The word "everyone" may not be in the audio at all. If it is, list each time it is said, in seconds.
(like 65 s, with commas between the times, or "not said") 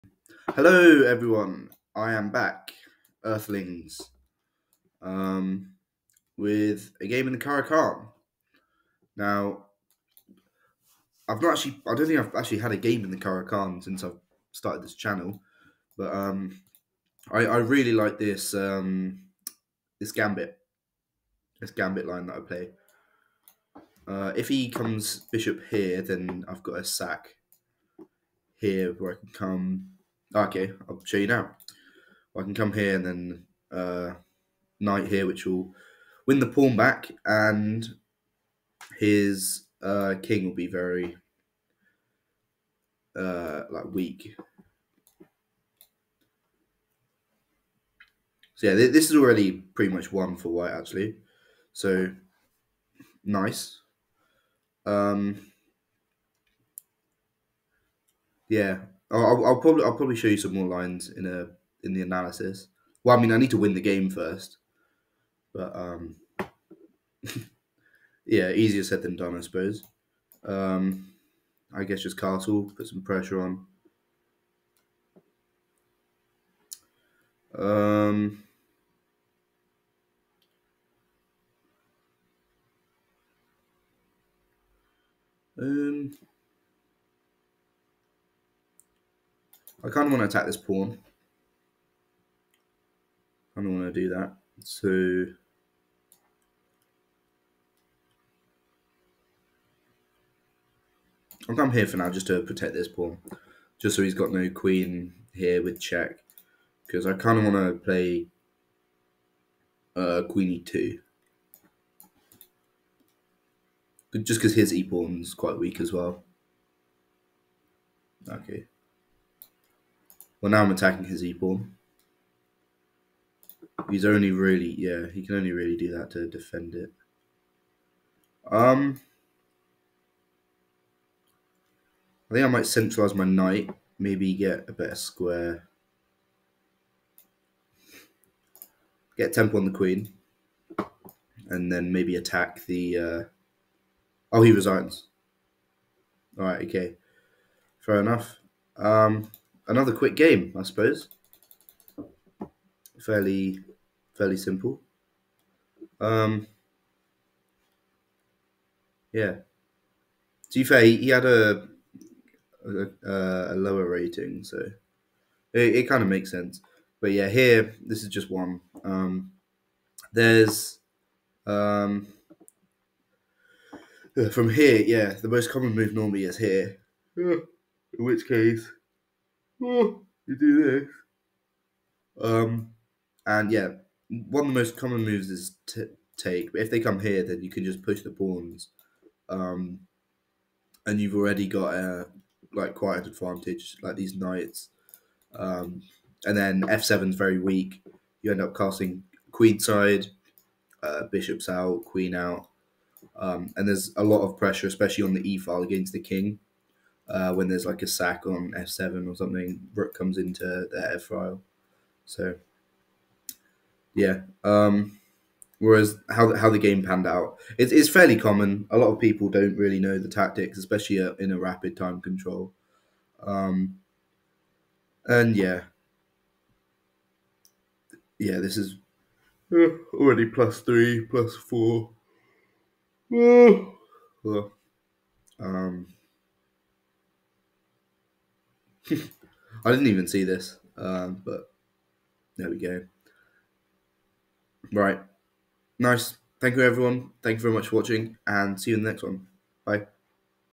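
1 s, 246 s.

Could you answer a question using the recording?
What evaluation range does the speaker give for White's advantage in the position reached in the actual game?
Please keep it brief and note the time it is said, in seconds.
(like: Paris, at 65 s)
+3 to +4, at 230 s.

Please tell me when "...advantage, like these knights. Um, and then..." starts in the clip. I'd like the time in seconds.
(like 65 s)
193 s.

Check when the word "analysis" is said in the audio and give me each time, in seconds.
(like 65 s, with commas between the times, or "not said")
62 s.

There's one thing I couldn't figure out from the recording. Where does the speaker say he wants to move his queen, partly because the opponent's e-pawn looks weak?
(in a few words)
e2.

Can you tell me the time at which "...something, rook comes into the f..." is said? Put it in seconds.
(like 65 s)
209 s.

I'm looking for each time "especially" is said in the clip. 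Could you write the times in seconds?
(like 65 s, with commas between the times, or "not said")
204 s, 220 s.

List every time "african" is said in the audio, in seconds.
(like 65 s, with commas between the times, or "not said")
not said.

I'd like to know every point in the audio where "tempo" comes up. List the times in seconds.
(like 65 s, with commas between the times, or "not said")
139 s.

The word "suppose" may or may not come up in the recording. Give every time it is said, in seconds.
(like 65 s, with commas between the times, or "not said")
69 s, 150 s.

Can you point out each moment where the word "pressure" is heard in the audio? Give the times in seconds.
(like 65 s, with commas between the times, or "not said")
73 s, 204 s.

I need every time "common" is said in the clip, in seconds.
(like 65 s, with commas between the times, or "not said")
175 s, 184 s, 218 s.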